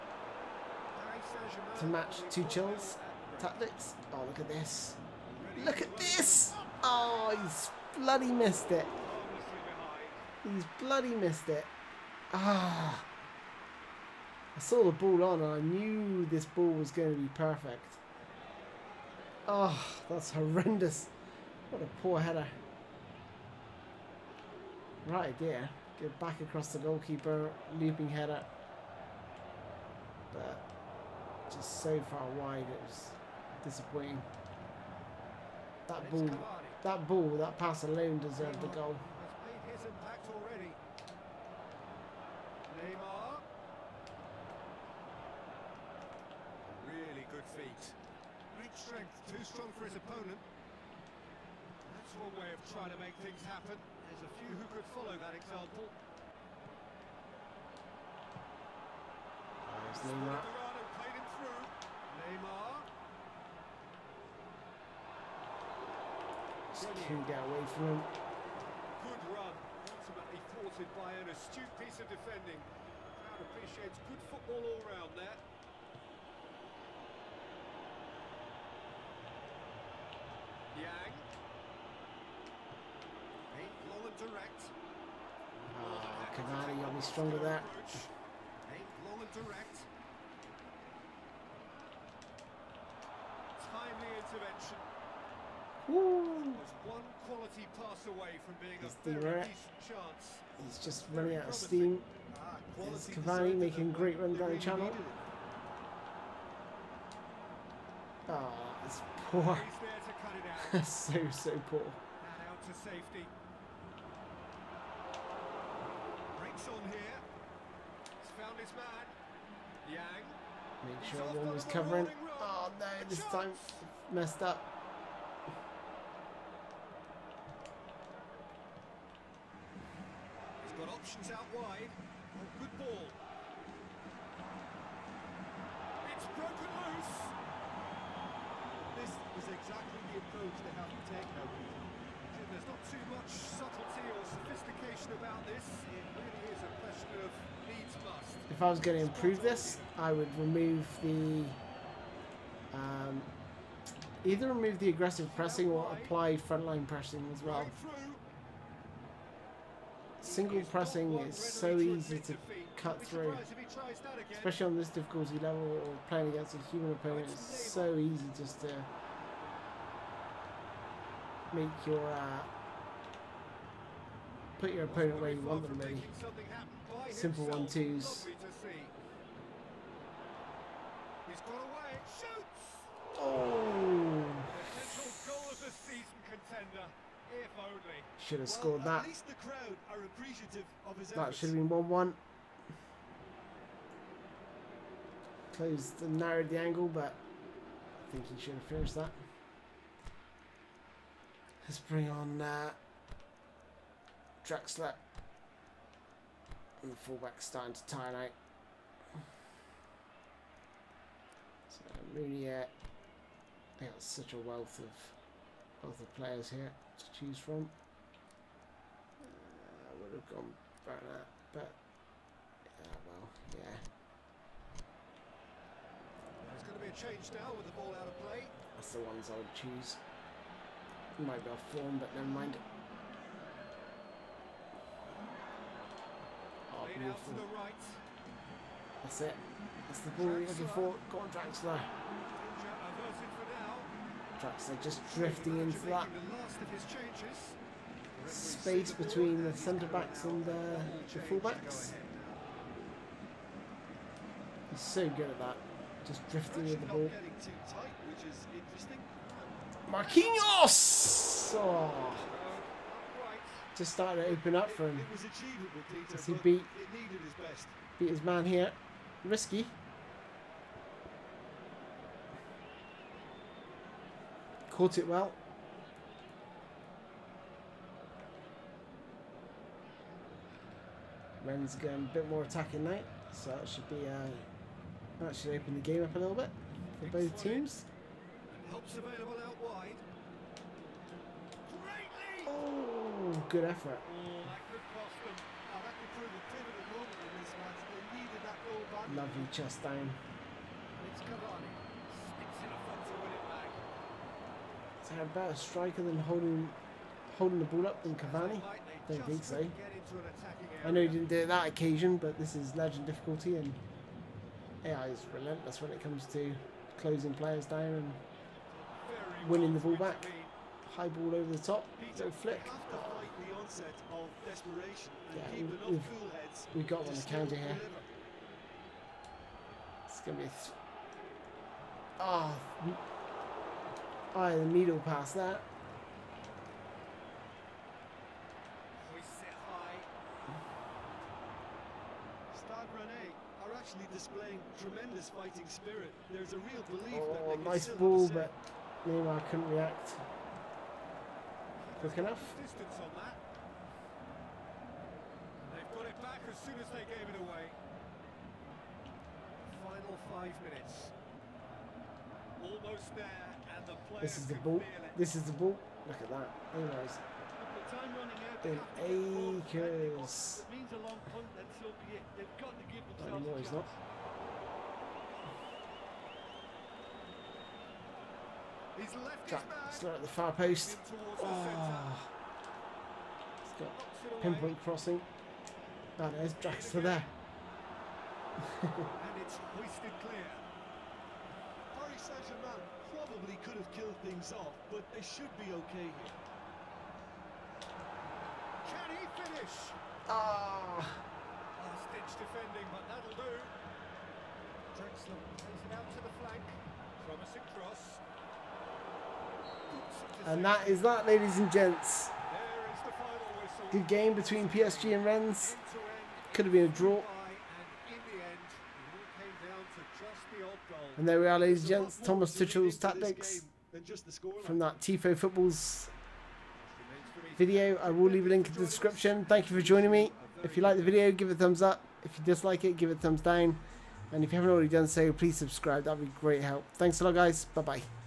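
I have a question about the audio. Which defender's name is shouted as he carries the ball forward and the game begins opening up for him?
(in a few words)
Marquinhos.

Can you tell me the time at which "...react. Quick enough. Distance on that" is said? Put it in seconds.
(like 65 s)
349 s.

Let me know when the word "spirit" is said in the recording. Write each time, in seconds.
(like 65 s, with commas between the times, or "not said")
345 s.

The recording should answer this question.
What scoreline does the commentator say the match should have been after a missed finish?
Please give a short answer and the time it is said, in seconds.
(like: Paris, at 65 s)
1-1, at 191 s.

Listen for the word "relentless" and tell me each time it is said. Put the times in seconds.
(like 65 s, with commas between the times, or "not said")
315 s.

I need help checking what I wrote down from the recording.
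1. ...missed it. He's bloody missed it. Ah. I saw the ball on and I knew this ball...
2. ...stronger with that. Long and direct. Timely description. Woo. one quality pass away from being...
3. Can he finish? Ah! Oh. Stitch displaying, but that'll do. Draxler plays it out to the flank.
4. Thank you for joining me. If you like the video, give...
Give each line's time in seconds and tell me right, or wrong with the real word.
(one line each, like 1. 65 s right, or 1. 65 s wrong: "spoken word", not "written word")
1. 8 s right
2. 86 s wrong: "intervention", not "description"
3. 398 s wrong: "defending", not "displaying"
4. 429 s right.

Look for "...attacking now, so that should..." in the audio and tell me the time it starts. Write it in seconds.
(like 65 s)
282 s.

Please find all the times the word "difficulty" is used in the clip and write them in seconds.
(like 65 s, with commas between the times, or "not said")
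164 s, 313 s.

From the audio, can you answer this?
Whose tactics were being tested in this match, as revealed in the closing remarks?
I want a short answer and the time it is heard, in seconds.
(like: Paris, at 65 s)
Thomas Tuchel, at 422 s.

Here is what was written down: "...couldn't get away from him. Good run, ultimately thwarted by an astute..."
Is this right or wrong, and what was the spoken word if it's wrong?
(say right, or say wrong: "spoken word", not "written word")
right.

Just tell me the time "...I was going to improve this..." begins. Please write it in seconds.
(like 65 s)
148 s.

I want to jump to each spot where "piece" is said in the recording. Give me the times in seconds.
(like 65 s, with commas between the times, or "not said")
71 s.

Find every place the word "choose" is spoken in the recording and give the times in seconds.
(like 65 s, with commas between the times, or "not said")
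217 s, 229 s.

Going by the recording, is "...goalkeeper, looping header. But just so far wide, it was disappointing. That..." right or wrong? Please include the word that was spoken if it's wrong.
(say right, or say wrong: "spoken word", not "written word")
right.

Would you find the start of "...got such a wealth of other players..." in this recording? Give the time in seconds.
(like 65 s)
213 s.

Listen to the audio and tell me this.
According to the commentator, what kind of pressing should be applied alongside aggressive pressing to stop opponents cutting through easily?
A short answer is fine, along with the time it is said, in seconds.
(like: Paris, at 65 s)
Frontline pressing, at 156 s.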